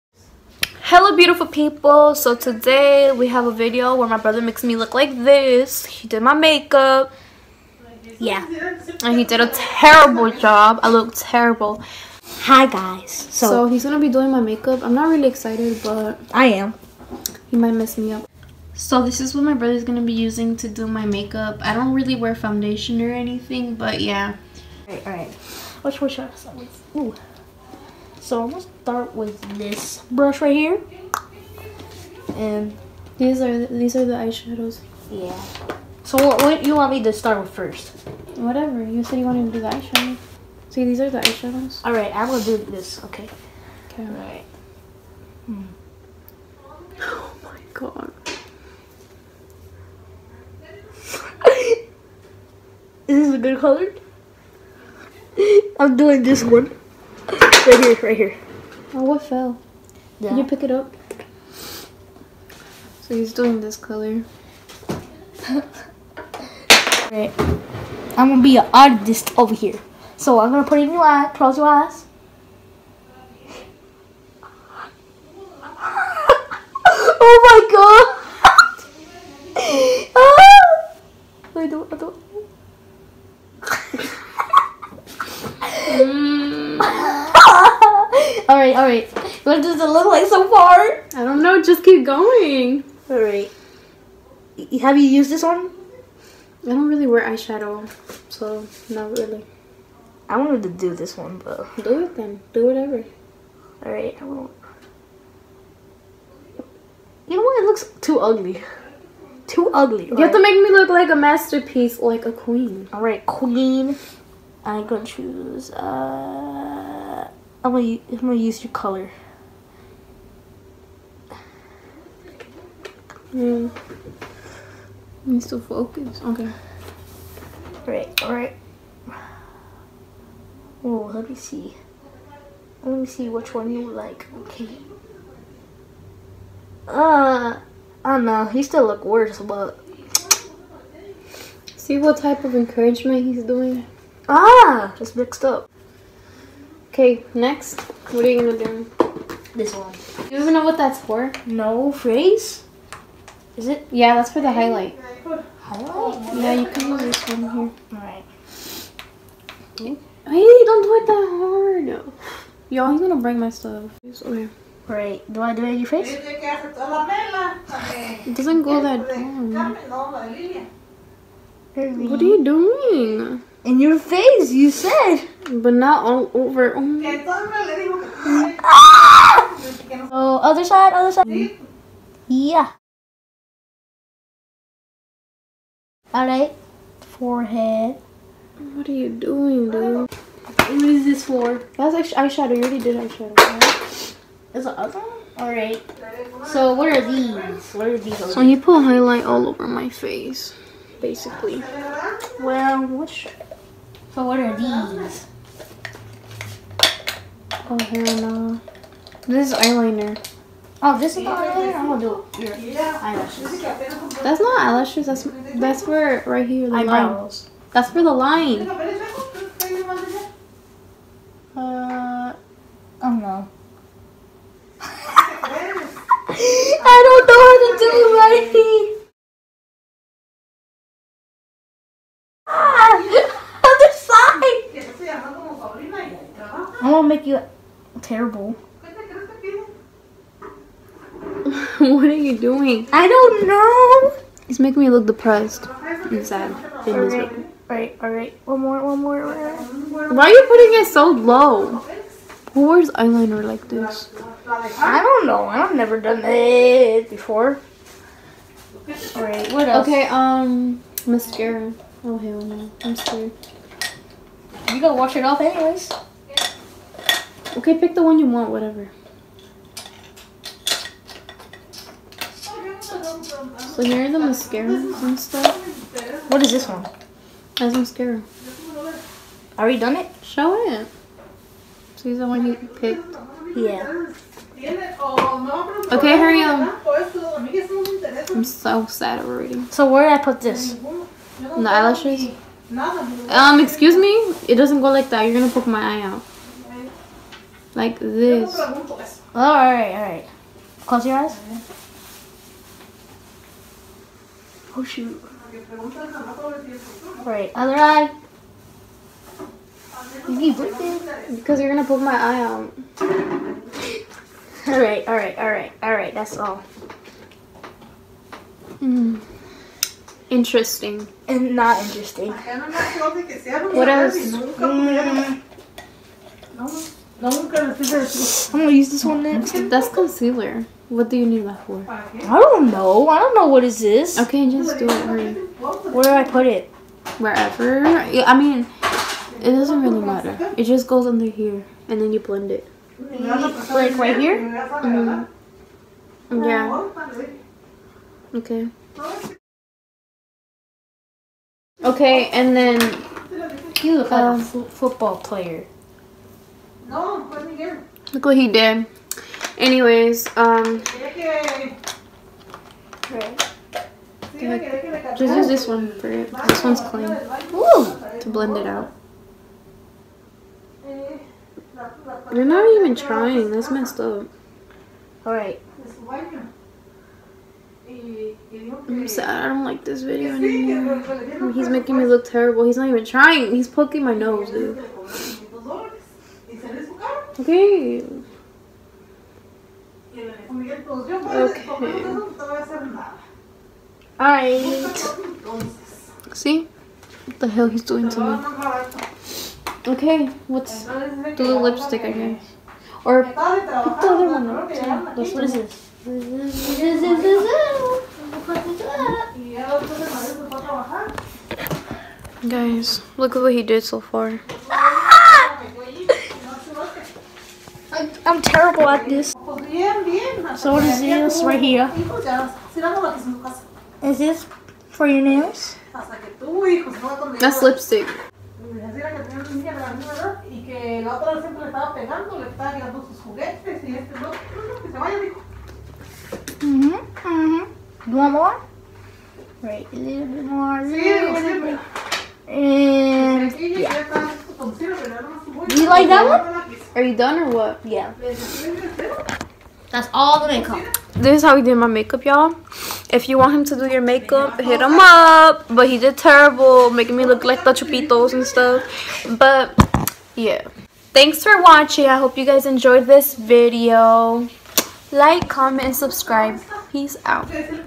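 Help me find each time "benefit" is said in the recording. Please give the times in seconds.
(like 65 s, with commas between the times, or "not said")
not said.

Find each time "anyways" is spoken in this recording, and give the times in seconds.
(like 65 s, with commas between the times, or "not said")
265 s, 359 s.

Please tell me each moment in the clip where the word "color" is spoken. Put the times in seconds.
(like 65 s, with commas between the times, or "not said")
53 s, 63 s, 118 s.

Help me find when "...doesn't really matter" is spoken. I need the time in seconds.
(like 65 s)
339 s.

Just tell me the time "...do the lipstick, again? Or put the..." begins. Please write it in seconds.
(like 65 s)
401 s.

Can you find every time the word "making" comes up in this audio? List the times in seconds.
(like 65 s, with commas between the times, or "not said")
244 s, 381 s, 456 s.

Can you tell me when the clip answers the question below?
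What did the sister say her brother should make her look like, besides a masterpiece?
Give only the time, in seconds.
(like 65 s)
111 s.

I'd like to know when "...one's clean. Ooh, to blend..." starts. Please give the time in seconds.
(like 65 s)
366 s.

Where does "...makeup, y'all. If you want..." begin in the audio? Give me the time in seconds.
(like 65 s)
451 s.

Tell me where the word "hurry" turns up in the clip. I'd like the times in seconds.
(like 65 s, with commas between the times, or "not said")
286 s, 335 s.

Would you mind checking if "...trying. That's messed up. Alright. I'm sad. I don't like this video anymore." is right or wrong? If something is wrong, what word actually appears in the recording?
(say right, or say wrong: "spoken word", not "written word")
right.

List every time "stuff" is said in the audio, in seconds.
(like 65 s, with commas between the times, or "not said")
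163 s, 275 s, 458 s.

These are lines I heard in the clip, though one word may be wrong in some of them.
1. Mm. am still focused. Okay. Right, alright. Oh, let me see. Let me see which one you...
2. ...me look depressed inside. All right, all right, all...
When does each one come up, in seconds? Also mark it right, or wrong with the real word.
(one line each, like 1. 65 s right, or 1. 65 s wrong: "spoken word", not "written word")
1. 123 s right
2. 244 s right.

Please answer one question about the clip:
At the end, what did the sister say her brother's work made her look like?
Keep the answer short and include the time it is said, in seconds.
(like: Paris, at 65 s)
the chupitos, at 457 s.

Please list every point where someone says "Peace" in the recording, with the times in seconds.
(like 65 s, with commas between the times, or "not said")
466 s.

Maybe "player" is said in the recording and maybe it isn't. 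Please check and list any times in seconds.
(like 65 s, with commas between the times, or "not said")
355 s.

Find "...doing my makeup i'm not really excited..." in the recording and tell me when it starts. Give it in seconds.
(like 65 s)
14 s.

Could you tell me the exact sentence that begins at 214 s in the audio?
That's not eyelashes, that's that's for right here the Eyebrows.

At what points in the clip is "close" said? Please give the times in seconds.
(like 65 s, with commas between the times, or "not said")
71 s, 300 s.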